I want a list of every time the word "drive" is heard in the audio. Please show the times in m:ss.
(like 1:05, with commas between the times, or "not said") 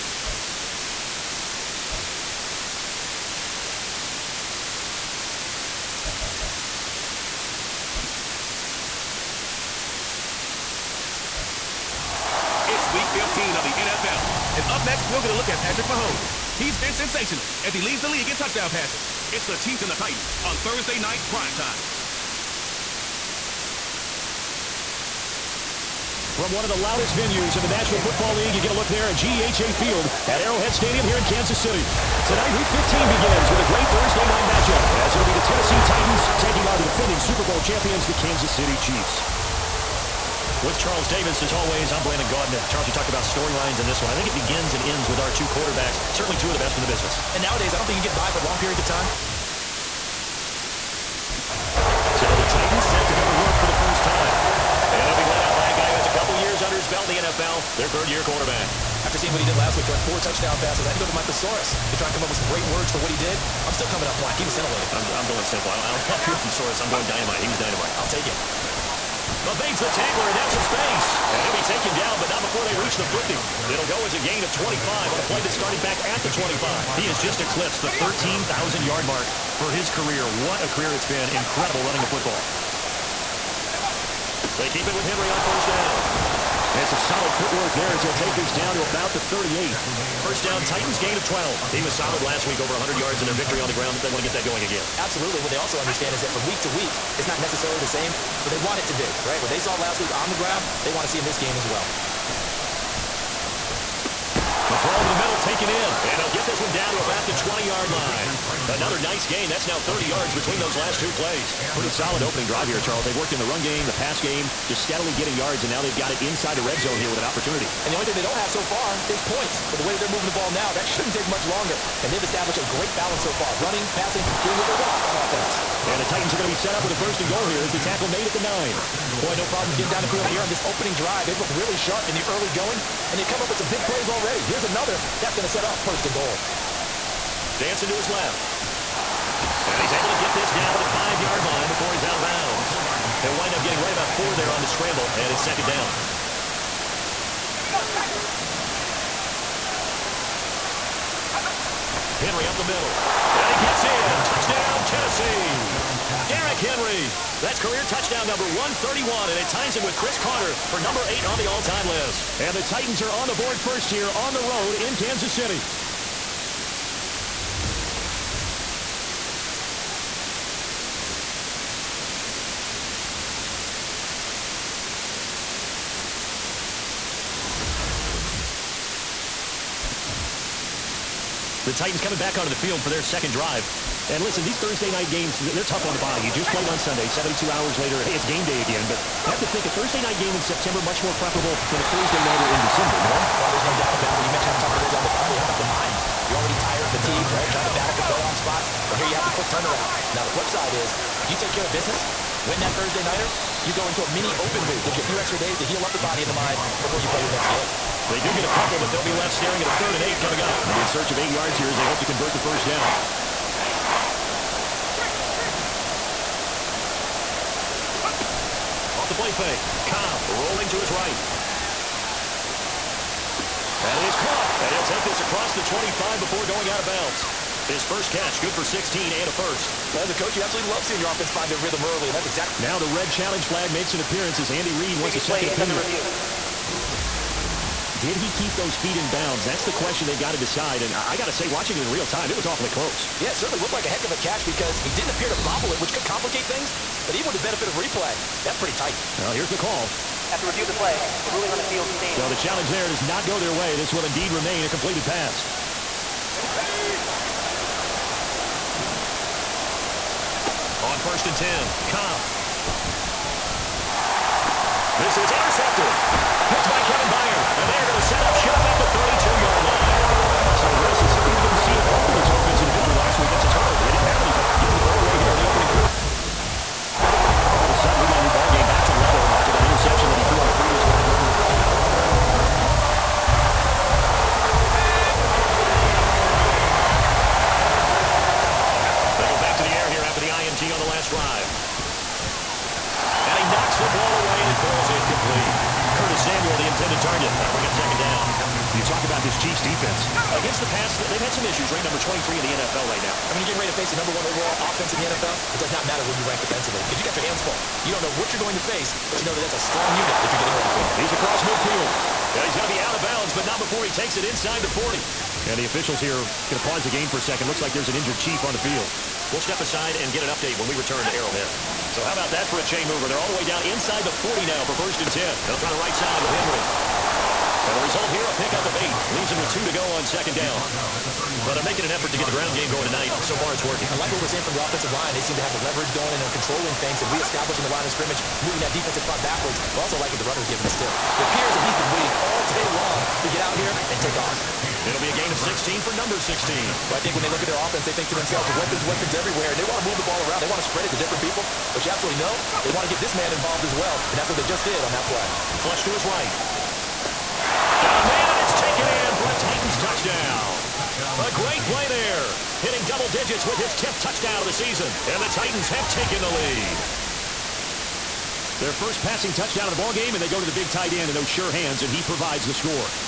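1:52, 2:10, 3:03.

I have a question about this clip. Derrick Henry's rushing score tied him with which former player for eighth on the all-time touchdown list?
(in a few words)
Cris Carter.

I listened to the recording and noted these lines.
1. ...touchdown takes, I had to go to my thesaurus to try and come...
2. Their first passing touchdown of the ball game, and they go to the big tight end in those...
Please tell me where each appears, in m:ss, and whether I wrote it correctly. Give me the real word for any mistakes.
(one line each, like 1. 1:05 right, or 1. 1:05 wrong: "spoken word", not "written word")
1. 1:00 wrong: "passes", not "takes"
2. 6:08 right.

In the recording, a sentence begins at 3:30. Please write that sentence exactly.
They'll be in search of eight yards here as they hope to convert the first down.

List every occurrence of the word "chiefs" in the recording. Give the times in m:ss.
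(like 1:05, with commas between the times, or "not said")
0:19, 0:38, 5:18.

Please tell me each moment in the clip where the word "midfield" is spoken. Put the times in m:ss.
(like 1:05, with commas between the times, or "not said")
5:11.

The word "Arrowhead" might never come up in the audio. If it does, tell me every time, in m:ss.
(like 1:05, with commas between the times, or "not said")
0:30, 5:21.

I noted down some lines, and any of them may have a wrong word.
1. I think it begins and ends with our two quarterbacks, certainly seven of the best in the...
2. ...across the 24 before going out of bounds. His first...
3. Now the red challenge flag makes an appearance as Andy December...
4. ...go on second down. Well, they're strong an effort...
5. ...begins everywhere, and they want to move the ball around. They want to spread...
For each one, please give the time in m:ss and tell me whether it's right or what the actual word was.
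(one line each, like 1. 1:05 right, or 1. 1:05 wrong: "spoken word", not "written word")
1. 0:44 wrong: "two", not "seven"
2. 3:45 wrong: "25", not "24"
3. 3:52 wrong: "Reid", not "December"
4. 5:29 wrong: "making", not "strong"
5. 5:48 wrong: "weapons", not "begins".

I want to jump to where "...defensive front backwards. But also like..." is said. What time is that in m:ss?
5:38.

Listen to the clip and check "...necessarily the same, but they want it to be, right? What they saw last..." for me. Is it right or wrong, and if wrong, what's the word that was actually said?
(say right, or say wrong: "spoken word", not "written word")
right.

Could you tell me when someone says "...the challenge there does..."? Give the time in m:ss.
4:12.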